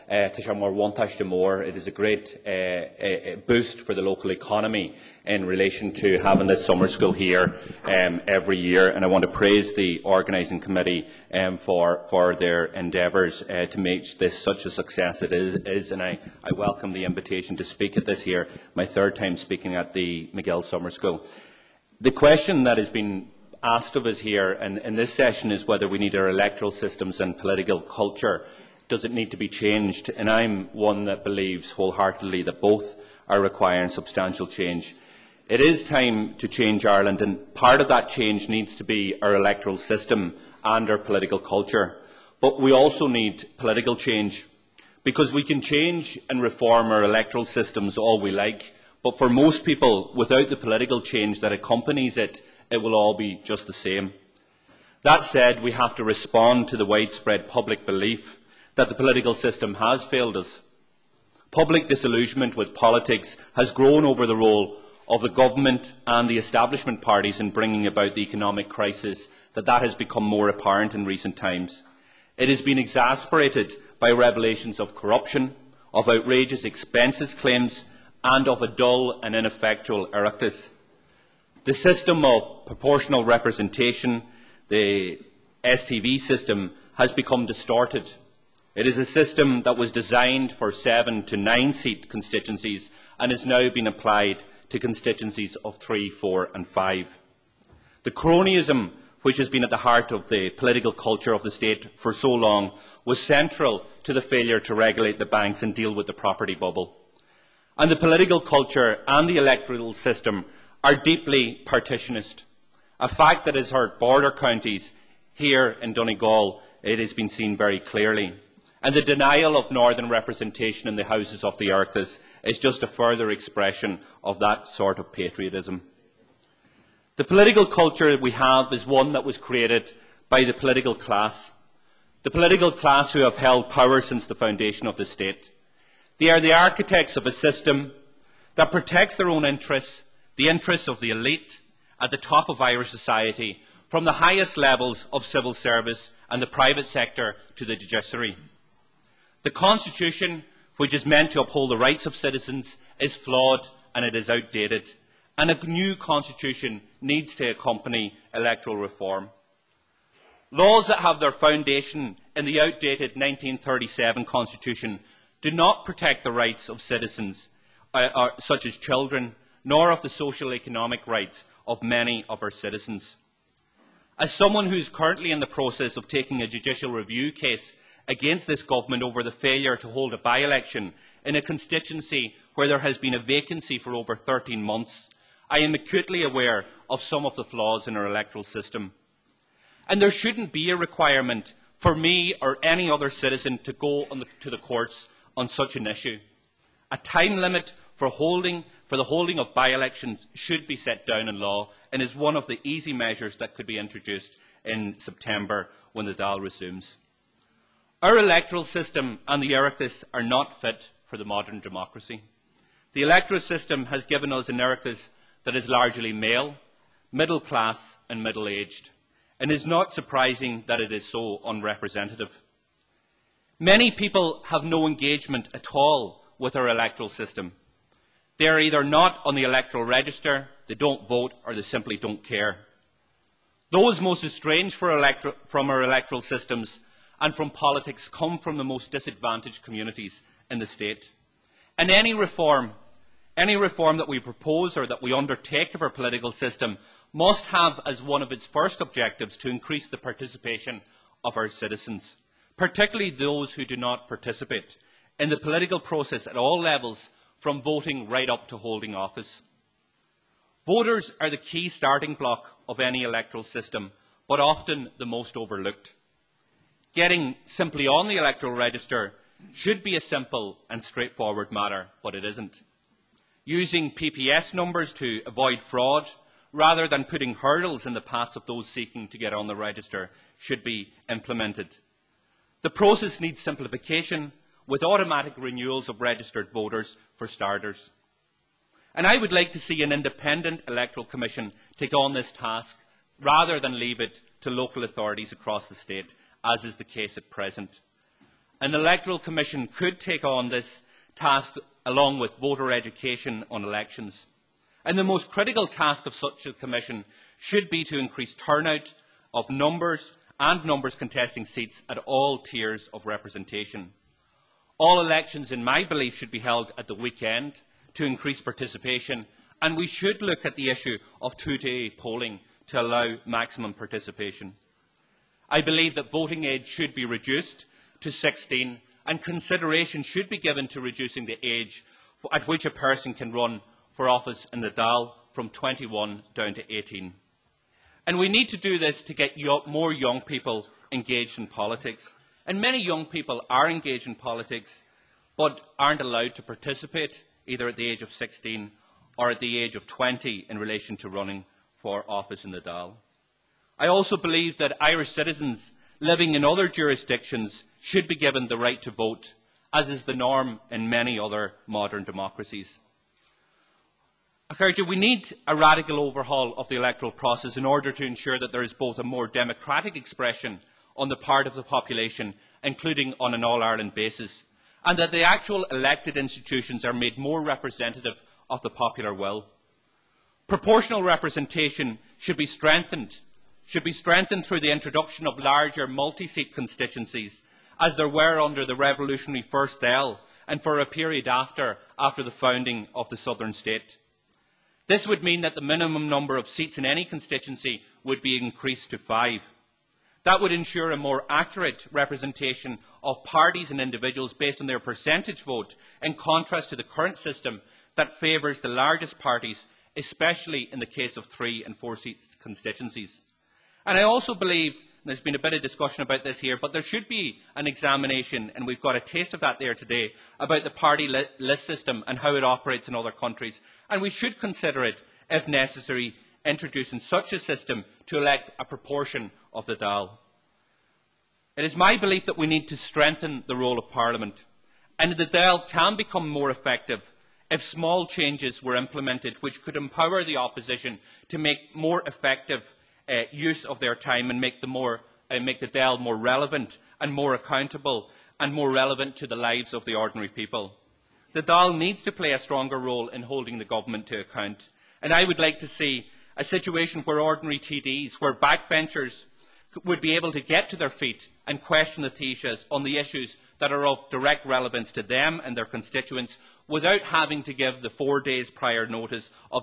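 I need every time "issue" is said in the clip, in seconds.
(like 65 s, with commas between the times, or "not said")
195 s, 320 s, 462 s.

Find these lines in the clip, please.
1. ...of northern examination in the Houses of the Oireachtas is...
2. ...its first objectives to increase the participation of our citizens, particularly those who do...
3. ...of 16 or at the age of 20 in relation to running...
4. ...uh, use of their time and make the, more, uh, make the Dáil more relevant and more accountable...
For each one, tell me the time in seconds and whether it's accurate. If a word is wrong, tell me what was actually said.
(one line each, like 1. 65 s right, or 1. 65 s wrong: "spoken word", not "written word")
1. 119 s wrong: "representation", not "examination"
2. 248 s right
3. 348 s right
4. 443 s right.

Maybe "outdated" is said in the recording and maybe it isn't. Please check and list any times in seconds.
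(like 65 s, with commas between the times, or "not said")
154 s, 162 s.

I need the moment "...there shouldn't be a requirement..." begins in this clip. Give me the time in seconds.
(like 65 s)
189 s.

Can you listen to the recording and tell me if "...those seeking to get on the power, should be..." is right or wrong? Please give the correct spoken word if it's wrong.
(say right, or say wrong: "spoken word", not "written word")
wrong: "register", not "power".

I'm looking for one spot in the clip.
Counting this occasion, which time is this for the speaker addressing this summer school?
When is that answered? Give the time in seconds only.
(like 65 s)
18 s.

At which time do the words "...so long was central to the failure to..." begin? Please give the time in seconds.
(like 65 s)
102 s.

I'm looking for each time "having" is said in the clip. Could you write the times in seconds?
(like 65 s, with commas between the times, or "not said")
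6 s, 466 s.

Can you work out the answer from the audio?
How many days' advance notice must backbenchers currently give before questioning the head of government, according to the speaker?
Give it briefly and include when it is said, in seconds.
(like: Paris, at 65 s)
4 days, at 467 s.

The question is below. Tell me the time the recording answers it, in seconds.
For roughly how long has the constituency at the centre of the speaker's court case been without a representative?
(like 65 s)
183 s.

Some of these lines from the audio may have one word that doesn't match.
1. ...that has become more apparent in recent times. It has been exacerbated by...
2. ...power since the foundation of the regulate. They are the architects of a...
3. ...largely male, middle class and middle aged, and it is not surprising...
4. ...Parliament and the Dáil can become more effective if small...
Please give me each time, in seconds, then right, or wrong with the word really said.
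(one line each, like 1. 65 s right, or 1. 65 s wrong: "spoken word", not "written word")
1. 69 s right
2. 133 s wrong: "state", not "regulate"
3. 215 s right
4. 433 s right.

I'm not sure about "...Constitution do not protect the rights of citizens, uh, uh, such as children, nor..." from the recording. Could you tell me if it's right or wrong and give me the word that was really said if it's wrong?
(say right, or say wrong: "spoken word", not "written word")
right.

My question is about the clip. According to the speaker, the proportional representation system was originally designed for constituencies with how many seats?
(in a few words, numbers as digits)
7 to 9.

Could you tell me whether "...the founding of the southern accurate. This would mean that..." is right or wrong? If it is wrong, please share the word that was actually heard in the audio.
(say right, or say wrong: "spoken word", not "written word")
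wrong: "state", not "accurate".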